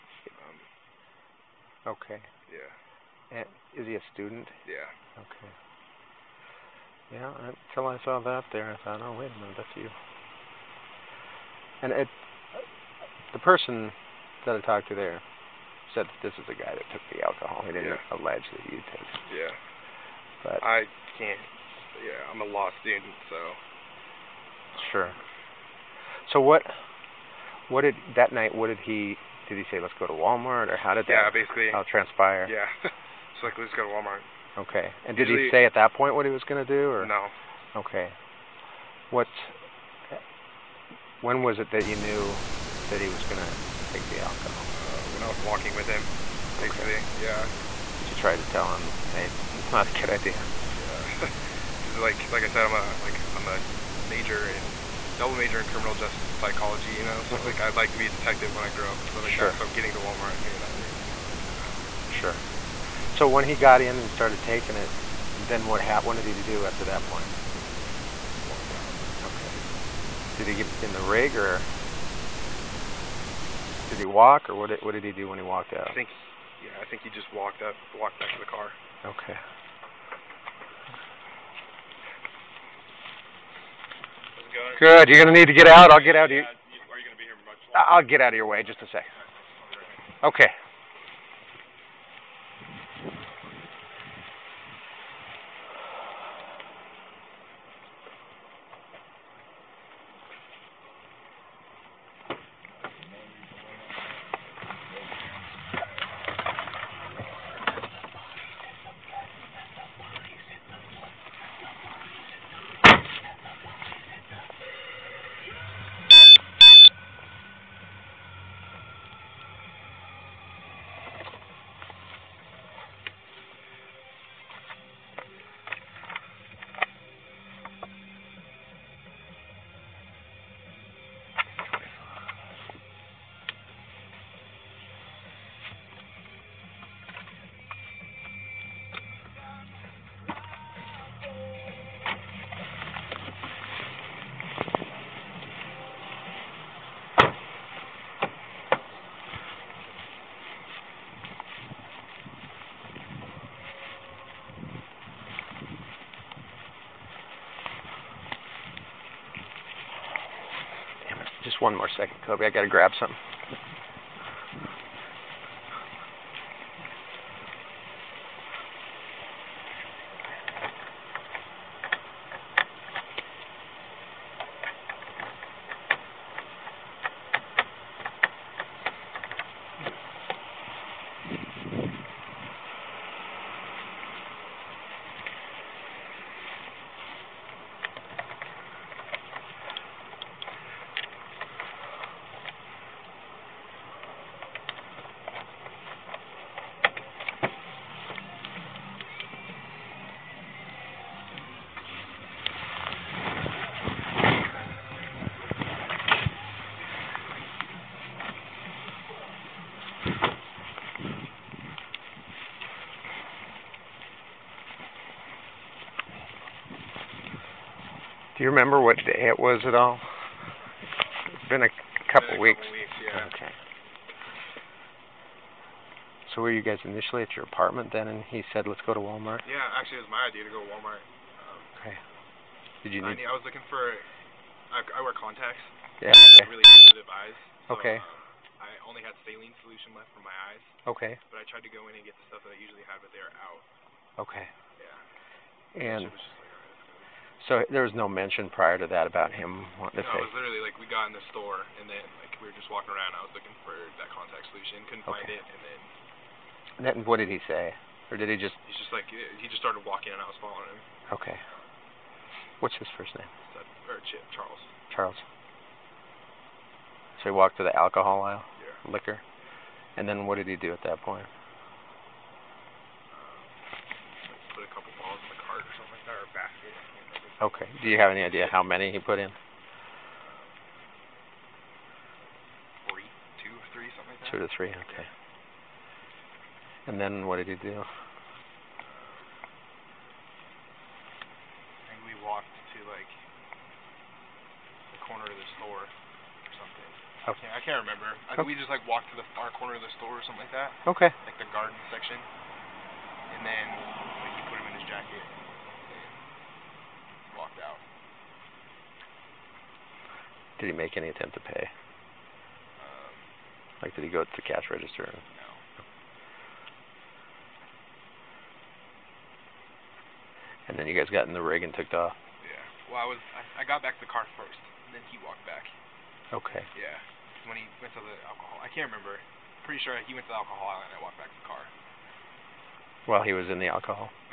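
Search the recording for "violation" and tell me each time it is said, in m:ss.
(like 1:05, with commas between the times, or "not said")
not said.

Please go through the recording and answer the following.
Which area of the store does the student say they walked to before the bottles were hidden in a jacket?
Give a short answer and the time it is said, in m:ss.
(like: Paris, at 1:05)
Garden section, at 5:01.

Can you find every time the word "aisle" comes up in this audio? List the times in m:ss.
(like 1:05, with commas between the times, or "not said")
4:28.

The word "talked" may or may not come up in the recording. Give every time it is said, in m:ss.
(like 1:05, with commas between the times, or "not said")
0:14.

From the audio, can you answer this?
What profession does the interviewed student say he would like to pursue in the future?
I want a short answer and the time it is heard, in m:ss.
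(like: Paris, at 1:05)
Detective, at 0:58.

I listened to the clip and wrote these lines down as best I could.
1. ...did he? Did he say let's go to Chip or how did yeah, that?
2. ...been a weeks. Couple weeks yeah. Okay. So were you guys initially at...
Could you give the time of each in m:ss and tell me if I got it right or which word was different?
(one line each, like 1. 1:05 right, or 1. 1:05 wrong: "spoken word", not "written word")
1. 0:28 wrong: "Walmart", not "Chip"
2. 3:42 right.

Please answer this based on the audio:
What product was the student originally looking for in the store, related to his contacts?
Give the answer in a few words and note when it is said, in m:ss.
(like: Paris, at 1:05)
Contact solution, at 4:14.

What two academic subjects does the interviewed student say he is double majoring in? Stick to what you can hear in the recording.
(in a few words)
Criminal justice and psychology.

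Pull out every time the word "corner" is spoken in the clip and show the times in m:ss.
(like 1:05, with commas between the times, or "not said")
4:55, 4:59.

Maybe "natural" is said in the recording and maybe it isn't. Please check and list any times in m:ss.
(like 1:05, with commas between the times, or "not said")
not said.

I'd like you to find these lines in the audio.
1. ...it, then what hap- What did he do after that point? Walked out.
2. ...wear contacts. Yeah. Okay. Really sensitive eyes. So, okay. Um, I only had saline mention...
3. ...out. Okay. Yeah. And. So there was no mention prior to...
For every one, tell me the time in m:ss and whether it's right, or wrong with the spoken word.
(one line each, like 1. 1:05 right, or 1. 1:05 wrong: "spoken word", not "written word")
1. 1:04 right
2. 3:55 wrong: "solution", not "mention"
3. 4:03 right.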